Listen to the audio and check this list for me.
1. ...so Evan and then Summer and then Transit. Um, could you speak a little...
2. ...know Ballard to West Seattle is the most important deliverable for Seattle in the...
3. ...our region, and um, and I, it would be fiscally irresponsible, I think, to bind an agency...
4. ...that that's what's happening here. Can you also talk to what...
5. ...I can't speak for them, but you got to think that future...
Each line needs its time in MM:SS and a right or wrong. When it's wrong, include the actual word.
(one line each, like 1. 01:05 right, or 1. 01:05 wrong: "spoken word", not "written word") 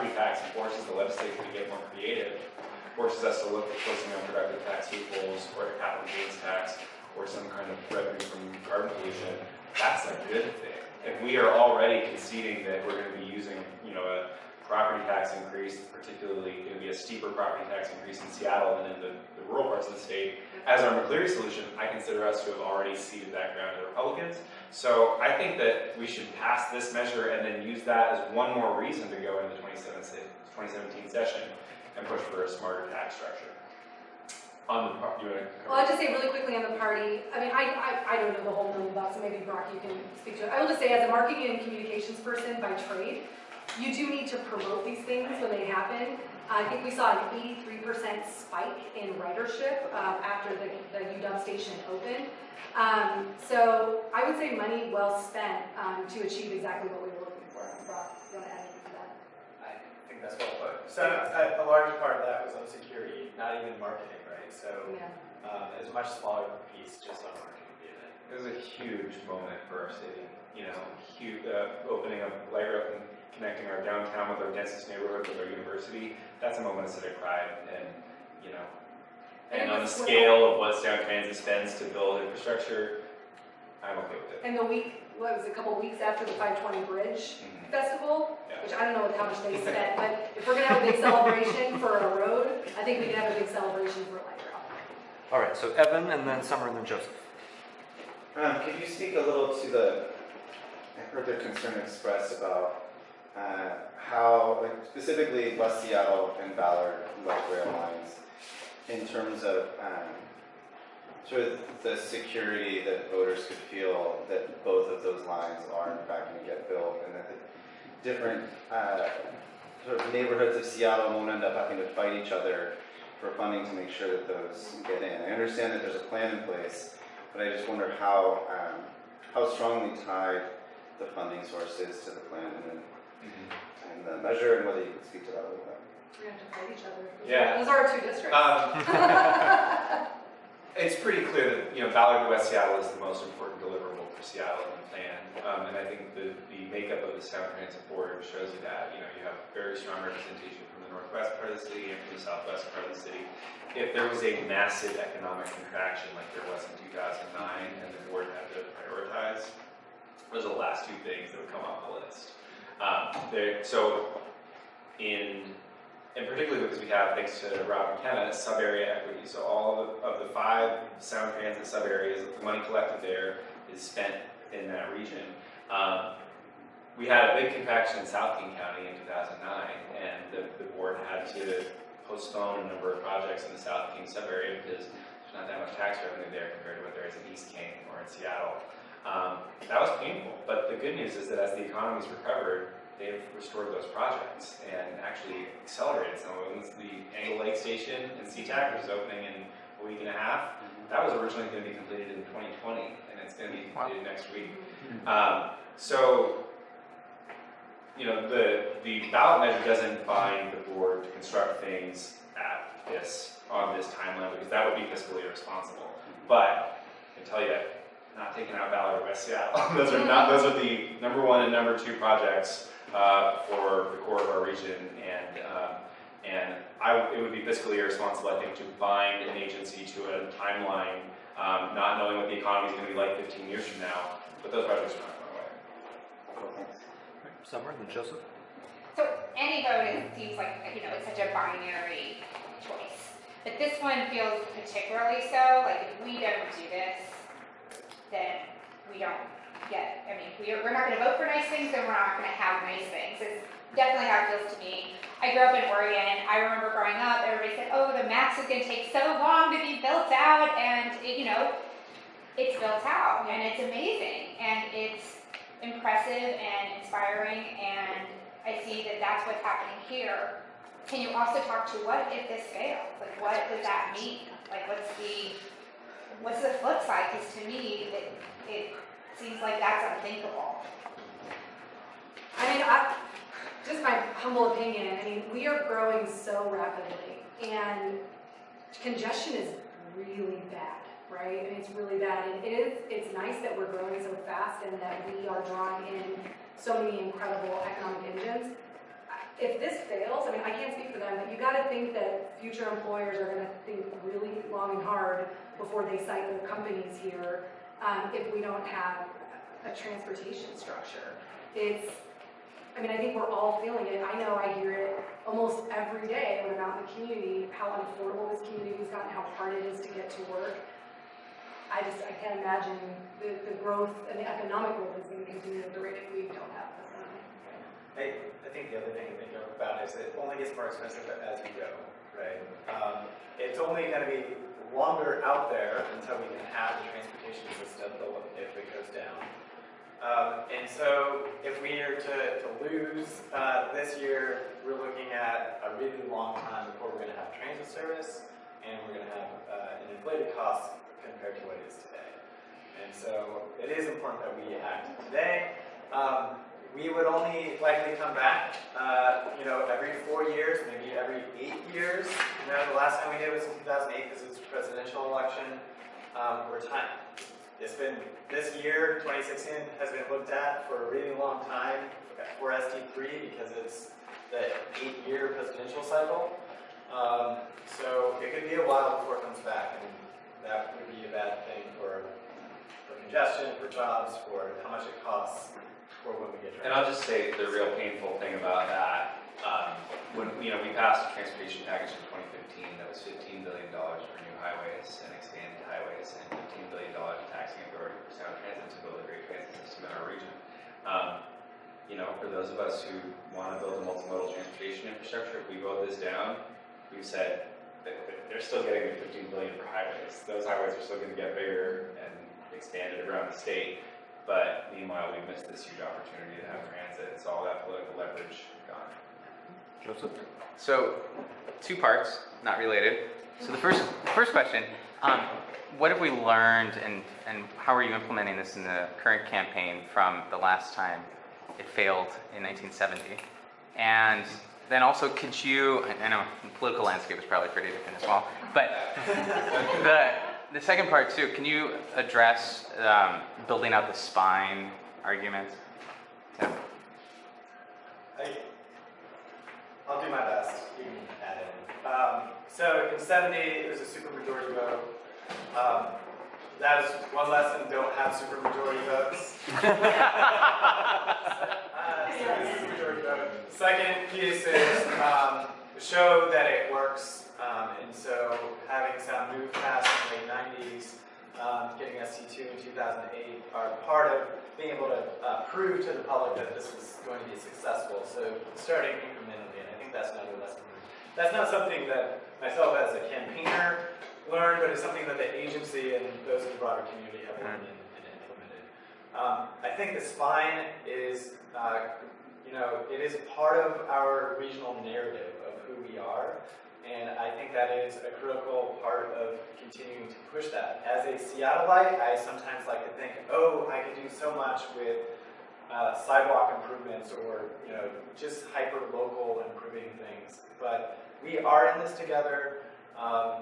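1. 01:35 wrong: "Joseph", not "Transit"
2. 02:21 right
3. 03:44 right
4. 04:28 right
5. 05:00 right.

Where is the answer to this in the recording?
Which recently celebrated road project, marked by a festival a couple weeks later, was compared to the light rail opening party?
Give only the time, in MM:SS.
01:26.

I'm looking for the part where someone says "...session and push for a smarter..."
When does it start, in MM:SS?
00:31.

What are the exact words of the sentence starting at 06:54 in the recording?
But meanwhile, we missed this huge opportunity to have transit.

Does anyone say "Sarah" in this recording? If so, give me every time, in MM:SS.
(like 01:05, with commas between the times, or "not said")
not said.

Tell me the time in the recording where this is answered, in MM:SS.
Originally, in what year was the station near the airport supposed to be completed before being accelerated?
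03:22.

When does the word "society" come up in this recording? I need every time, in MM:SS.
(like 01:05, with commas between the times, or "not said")
not said.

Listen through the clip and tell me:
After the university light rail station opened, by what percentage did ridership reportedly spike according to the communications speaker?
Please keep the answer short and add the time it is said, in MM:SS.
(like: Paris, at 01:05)
83%, at 00:47.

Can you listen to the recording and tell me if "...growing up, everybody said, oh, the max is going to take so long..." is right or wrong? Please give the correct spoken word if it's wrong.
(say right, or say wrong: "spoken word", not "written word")
right.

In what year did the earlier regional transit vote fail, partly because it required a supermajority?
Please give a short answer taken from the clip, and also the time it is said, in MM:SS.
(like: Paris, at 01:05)
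1970, at 07:12.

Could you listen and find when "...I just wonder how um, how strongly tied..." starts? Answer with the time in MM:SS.
02:07.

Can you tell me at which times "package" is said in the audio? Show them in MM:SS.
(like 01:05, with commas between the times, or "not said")
06:31.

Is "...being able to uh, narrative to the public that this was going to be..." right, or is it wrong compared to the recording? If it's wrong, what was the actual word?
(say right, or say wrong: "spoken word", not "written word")
wrong: "prove", not "narrative".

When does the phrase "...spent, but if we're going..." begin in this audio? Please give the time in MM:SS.
01:29.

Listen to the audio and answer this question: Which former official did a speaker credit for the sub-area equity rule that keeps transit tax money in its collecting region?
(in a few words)
Rob McKenna.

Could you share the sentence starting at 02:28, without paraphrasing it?
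You know, you have very strong representation from the northwest part of the city and from the southwest part of the city.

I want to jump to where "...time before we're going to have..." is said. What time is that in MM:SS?
05:46.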